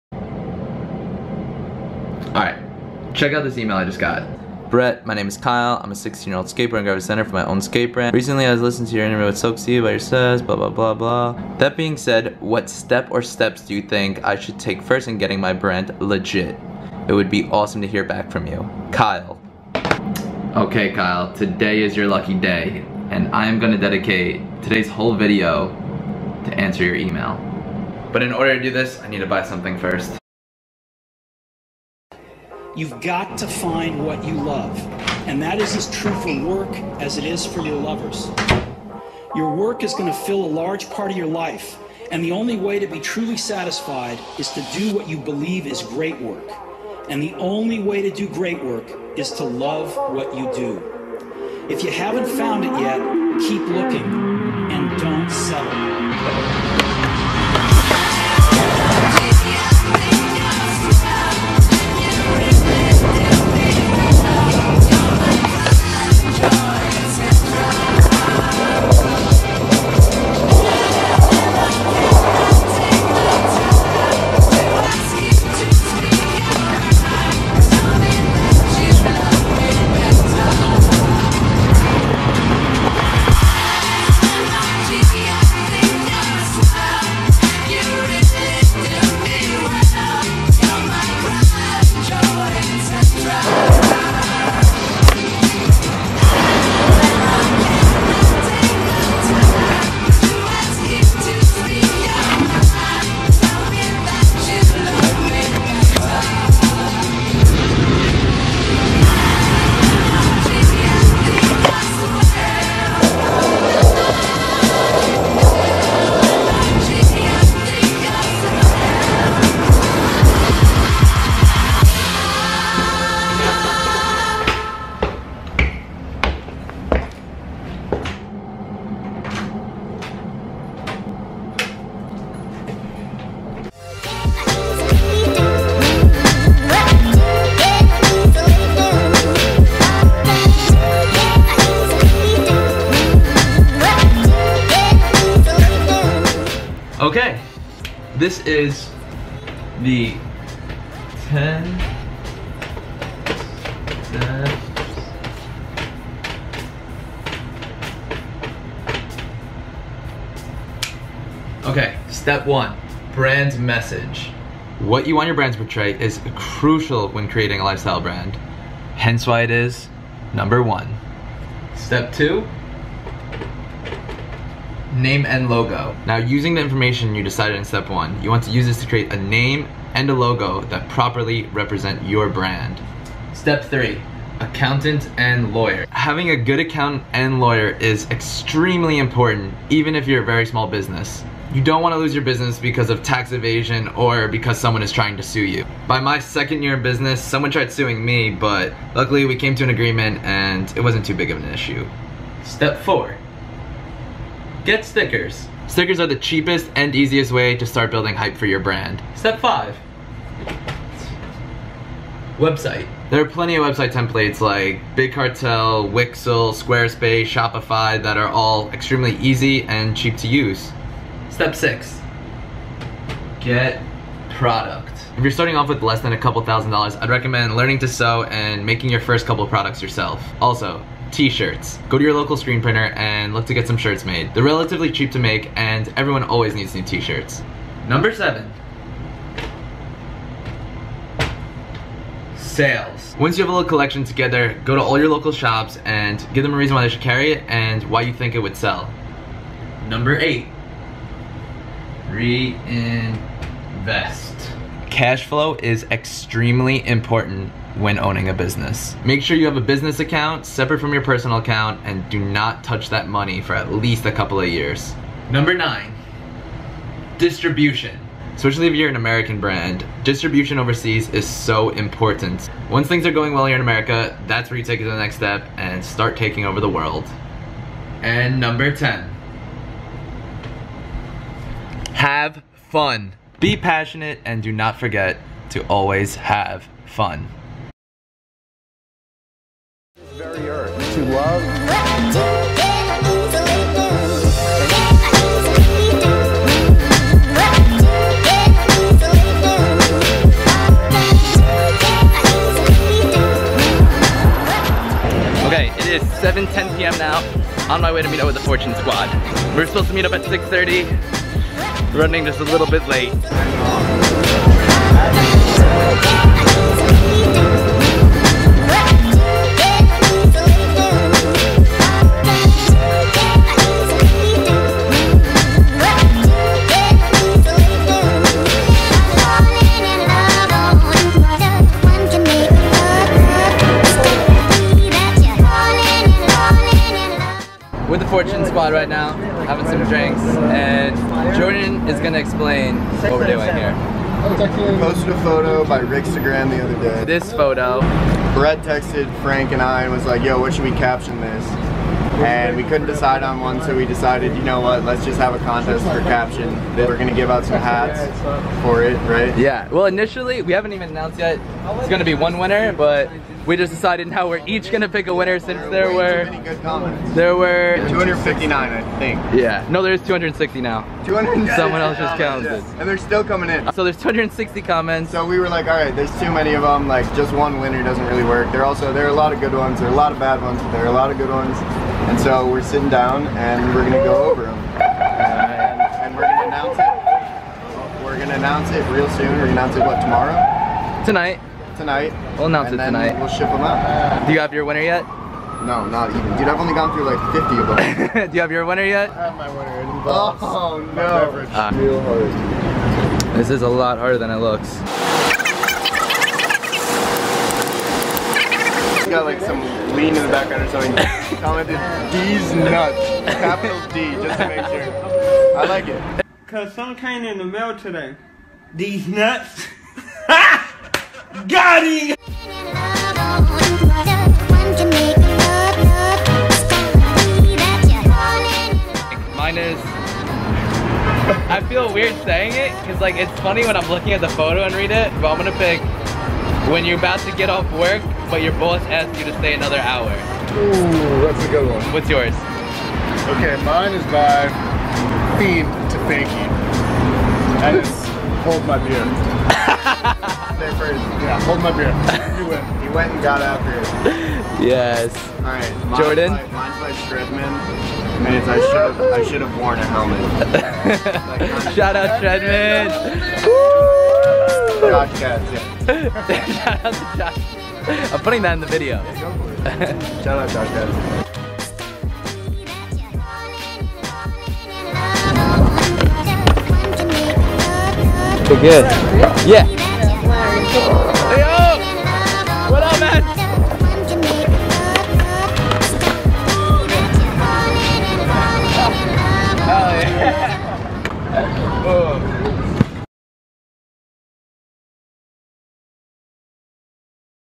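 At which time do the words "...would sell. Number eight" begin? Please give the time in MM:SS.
04:08.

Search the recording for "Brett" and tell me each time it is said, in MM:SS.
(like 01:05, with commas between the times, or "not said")
00:04, 05:48.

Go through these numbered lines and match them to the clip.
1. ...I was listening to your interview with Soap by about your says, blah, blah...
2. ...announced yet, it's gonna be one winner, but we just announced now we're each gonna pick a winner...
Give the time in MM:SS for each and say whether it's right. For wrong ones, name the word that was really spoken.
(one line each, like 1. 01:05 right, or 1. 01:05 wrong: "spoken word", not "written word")
1. 00:08 right
2. 06:00 wrong: "decided", not "announced".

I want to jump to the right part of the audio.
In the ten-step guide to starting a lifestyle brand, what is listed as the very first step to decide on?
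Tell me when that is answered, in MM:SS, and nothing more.
02:43.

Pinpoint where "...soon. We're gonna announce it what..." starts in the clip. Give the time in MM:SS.
06:29.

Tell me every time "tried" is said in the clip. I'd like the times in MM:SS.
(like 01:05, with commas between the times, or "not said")
03:17.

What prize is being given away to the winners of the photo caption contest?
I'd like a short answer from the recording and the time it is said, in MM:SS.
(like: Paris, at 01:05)
Hats, at 05:57.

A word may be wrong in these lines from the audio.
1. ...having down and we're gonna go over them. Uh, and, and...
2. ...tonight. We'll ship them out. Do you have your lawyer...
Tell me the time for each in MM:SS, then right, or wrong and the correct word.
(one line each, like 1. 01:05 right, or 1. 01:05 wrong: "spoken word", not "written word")
1. 06:22 wrong: "sitting", not "having"
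2. 06:32 wrong: "winner", not "lawyer".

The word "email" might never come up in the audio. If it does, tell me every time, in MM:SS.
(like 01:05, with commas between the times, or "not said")
00:03, 00:26.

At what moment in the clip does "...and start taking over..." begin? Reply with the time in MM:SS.
04:35.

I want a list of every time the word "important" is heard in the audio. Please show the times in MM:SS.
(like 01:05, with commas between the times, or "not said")
03:08, 04:16, 04:31.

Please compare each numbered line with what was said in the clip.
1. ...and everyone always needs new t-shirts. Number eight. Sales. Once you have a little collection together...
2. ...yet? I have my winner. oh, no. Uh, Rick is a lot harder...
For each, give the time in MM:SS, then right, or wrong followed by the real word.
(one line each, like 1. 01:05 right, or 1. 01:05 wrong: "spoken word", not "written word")
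1. 03:55 wrong: "seven", not "eight"
2. 06:38 wrong: "This", not "Rick".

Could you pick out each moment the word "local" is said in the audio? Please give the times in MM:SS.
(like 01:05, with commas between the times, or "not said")
03:52, 04:05.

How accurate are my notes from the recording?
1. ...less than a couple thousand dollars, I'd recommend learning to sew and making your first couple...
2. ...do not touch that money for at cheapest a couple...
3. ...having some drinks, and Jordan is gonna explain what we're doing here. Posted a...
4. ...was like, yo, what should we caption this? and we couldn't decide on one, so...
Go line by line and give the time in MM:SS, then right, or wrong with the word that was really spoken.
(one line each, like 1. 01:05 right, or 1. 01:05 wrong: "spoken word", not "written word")
1. 03:45 right
2. 04:22 wrong: "least", not "cheapest"
3. 05:39 right
4. 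05:49 right.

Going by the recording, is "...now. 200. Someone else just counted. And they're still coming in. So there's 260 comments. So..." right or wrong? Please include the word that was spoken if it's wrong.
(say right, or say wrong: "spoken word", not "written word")
right.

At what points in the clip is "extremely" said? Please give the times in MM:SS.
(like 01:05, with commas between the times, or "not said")
03:08, 03:38, 04:15.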